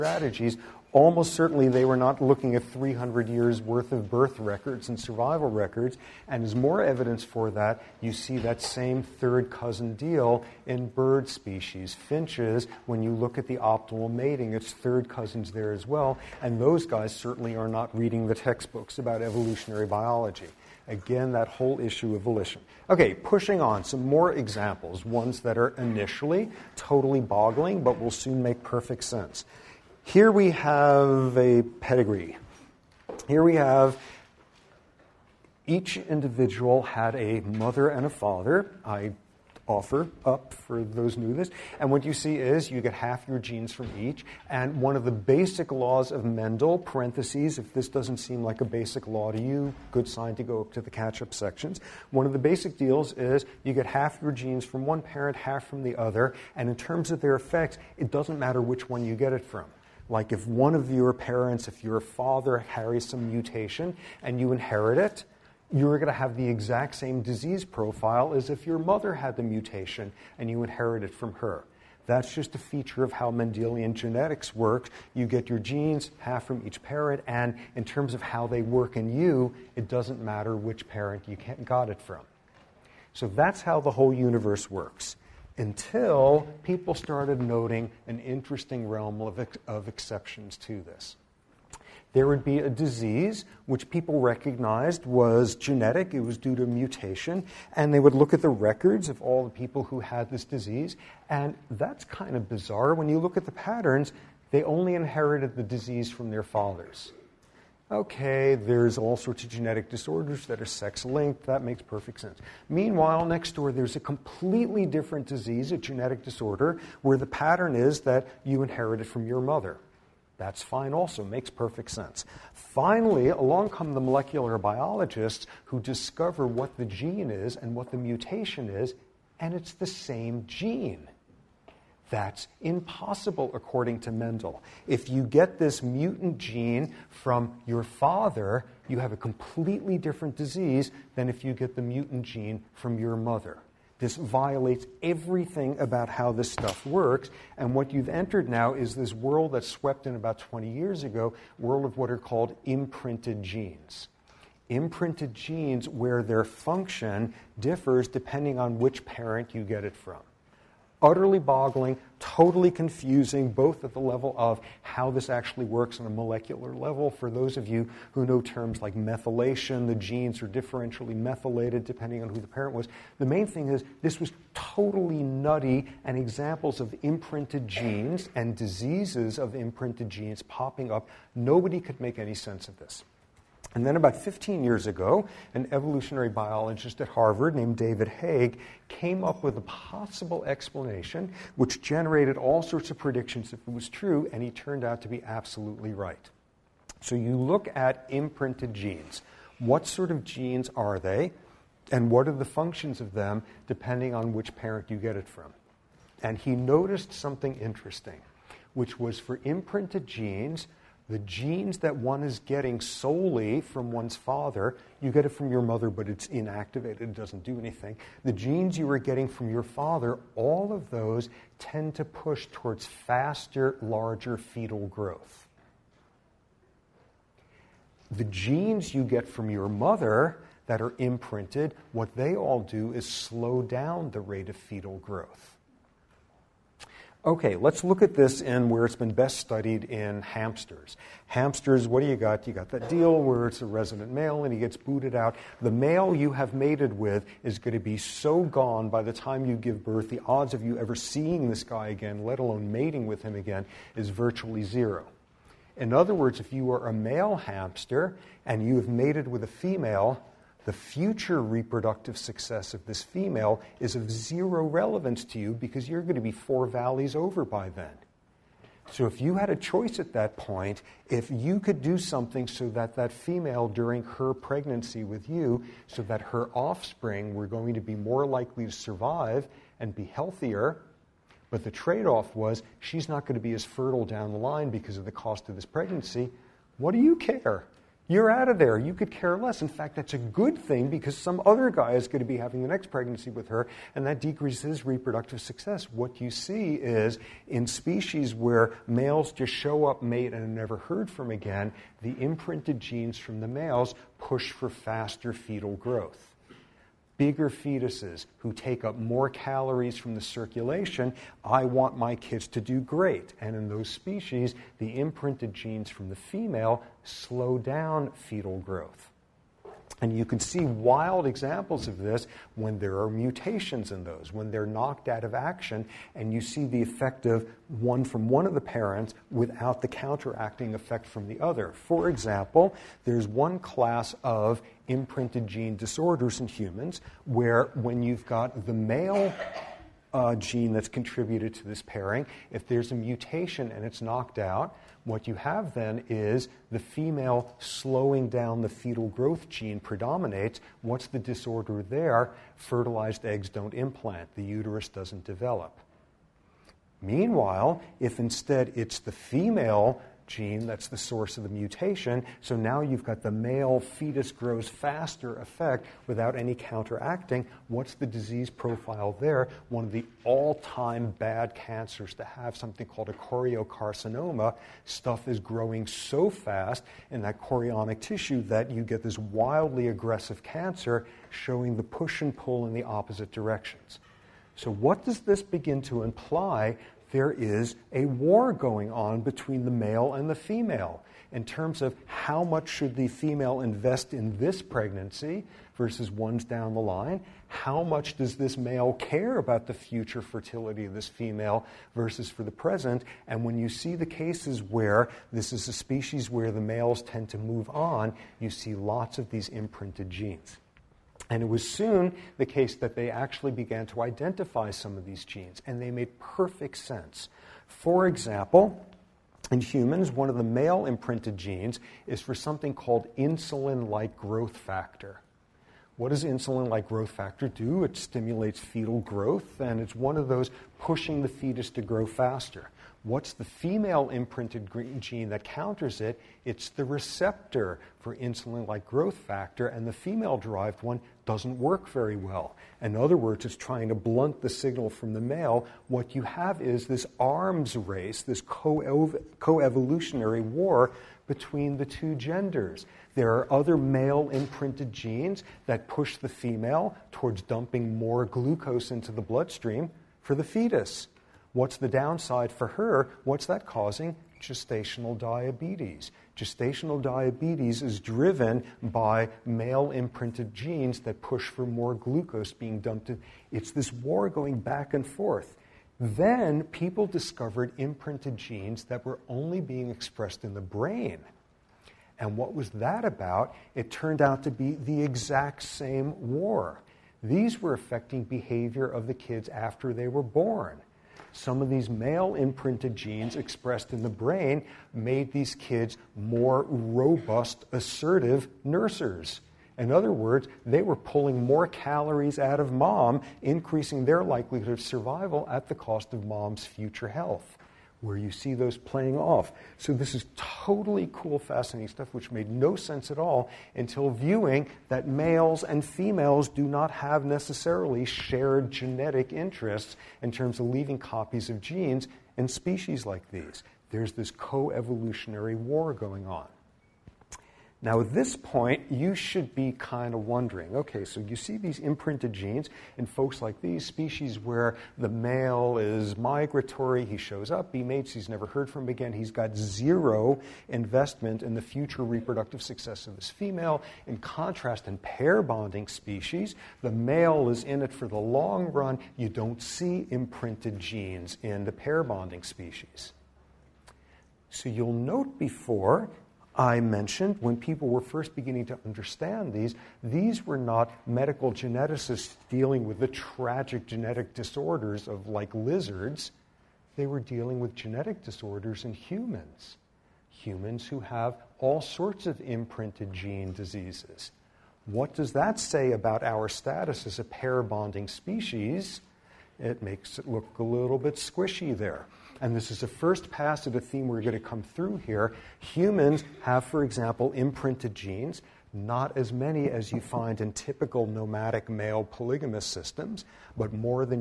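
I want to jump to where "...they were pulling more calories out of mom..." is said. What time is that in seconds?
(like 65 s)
500 s.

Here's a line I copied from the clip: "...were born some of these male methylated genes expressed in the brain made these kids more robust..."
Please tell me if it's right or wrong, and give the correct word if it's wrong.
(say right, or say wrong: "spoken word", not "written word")
wrong: "imprinted", not "methylated".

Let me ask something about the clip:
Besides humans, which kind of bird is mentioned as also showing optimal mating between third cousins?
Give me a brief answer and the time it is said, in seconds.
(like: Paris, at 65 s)
Finches, at 11 s.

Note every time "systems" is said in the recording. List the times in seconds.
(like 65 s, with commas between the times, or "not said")
592 s.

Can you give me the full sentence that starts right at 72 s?
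That's just a feature of how Mendelian genetics works.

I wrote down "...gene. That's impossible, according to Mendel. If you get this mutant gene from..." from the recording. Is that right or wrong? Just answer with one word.
right.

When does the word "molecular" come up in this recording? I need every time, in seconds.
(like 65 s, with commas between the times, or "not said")
123 s, 166 s.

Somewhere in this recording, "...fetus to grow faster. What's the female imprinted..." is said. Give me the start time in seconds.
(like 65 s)
431 s.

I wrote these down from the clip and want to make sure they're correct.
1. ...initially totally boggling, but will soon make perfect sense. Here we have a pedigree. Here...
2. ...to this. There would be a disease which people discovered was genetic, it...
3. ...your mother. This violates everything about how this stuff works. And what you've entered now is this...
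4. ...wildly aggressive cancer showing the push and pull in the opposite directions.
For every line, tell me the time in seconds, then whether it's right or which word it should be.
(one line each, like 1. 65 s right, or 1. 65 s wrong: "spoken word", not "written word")
1. 25 s right
2. 90 s wrong: "recognized", not "discovered"
3. 142 s right
4. 379 s right.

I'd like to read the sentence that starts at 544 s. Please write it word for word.
In contrast, in pair bonding species, the male is in it for the long run.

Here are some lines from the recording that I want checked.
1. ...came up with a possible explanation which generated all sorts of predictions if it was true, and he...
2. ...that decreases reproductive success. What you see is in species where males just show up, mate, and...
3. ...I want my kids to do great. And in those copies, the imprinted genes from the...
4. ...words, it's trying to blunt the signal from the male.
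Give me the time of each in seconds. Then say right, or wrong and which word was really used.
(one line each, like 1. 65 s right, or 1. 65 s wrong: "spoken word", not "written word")
1. 188 s right
2. 294 s right
3. 311 s wrong: "species", not "copies"
4. 443 s right.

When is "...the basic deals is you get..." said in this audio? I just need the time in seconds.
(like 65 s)
52 s.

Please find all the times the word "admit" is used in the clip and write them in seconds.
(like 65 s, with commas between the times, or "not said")
not said.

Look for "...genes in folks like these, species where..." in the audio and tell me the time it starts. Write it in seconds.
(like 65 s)
532 s.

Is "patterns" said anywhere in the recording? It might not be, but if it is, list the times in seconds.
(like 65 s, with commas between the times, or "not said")
103 s, 117 s.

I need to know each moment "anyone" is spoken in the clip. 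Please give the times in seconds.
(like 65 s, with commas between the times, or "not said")
not said.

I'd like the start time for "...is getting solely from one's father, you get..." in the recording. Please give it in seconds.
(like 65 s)
212 s.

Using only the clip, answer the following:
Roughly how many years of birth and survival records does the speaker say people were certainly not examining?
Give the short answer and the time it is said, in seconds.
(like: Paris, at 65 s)
300 years, at 2 s.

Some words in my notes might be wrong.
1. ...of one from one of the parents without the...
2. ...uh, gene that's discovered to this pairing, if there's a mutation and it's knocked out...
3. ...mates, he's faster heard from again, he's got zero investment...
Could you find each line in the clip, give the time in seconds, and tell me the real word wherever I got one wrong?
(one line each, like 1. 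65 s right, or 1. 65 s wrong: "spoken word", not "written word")
1. 327 s right
2. 340 s wrong: "contributed", not "discovered"
3. 537 s wrong: "never", not "faster".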